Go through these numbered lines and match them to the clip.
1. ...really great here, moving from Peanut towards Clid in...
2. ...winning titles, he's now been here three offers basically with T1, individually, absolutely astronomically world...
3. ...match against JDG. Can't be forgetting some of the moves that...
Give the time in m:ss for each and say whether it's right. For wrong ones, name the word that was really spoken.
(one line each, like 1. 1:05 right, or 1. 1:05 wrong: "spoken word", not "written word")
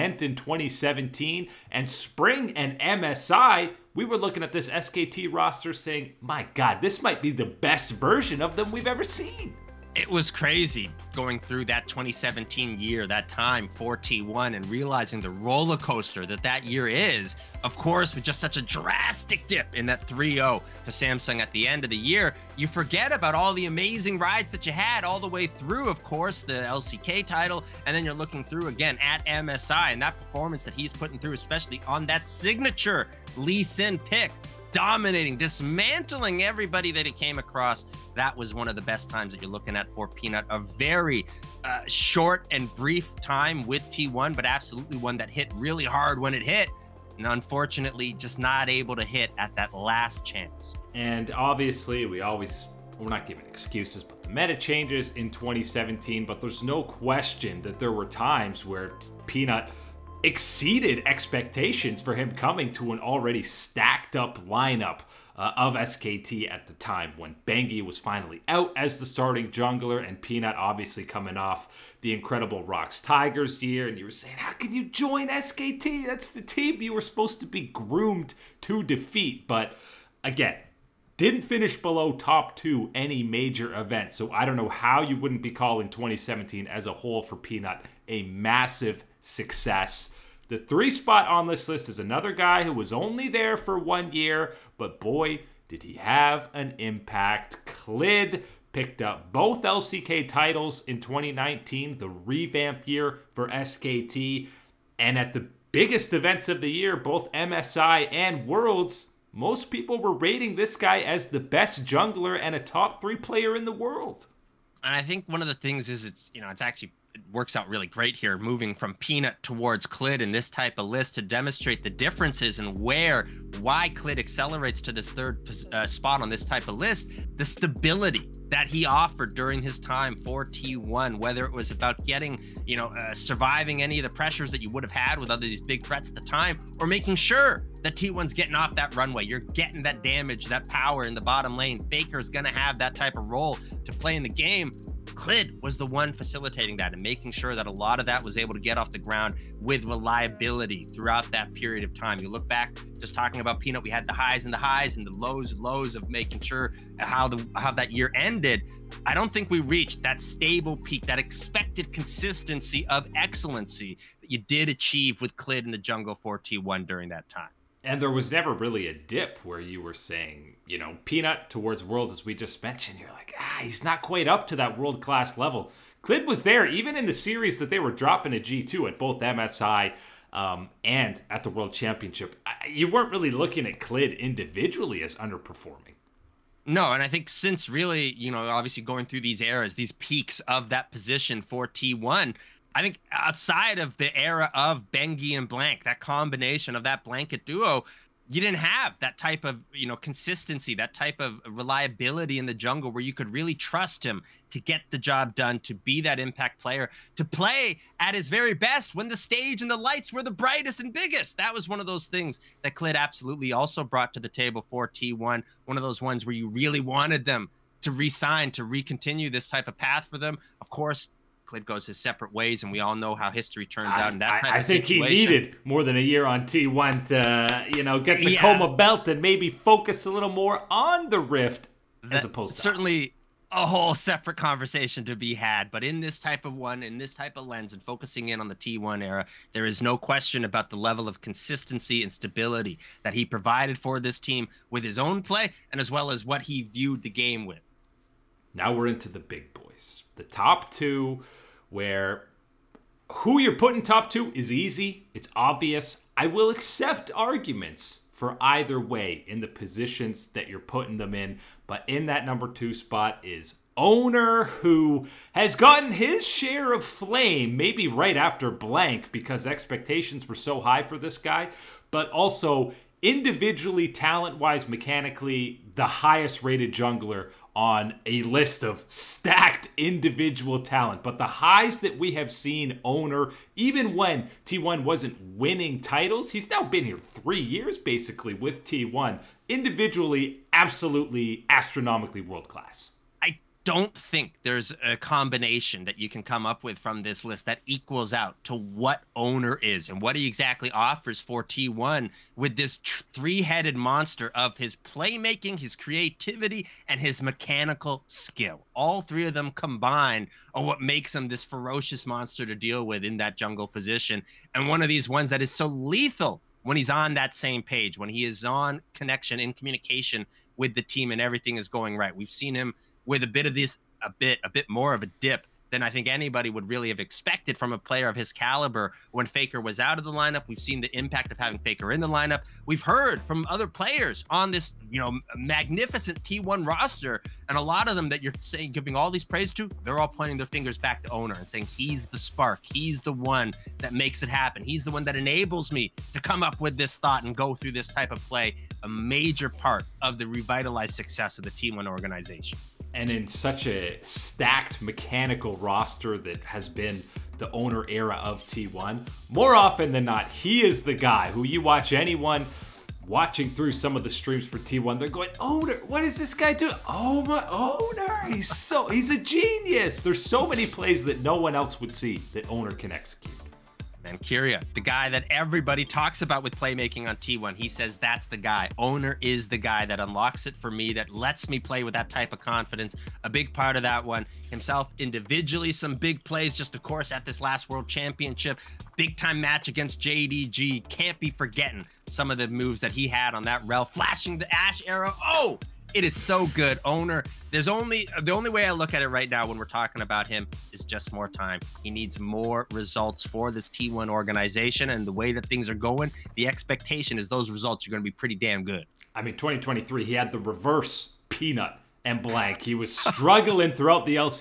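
1. 1:57 right
2. 4:45 wrong: "years", not "offers"
3. 6:29 right.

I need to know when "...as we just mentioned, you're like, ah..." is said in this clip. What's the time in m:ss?
2:52.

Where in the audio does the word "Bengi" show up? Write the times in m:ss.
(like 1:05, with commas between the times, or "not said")
1:07, 3:14.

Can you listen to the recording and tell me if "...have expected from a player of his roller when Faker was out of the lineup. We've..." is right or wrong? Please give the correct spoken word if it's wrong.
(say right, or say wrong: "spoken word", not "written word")
wrong: "caliber", not "roller".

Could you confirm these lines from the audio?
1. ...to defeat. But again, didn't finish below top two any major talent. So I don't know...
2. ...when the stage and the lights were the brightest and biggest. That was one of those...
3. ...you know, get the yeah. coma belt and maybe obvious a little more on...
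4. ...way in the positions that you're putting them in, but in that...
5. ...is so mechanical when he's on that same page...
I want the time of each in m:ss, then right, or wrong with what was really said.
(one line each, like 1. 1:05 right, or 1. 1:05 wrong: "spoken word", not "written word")
1. 1:18 wrong: "event", not "talent"
2. 3:28 right
3. 3:47 wrong: "focus", not "obvious"
4. 4:18 right
5. 5:15 wrong: "lethal", not "mechanical".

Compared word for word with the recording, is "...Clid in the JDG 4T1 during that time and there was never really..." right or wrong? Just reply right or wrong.
wrong.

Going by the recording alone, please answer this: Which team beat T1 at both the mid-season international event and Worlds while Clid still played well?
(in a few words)
G2.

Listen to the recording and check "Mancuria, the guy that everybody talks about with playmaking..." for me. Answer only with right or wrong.
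right.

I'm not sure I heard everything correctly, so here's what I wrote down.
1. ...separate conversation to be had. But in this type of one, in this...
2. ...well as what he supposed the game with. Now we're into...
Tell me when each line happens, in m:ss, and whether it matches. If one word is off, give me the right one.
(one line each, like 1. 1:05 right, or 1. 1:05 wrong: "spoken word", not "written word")
1. 3:53 right
2. 4:05 wrong: "viewed", not "supposed".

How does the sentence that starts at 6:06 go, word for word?
Oh my Oner, he's so he's a genius.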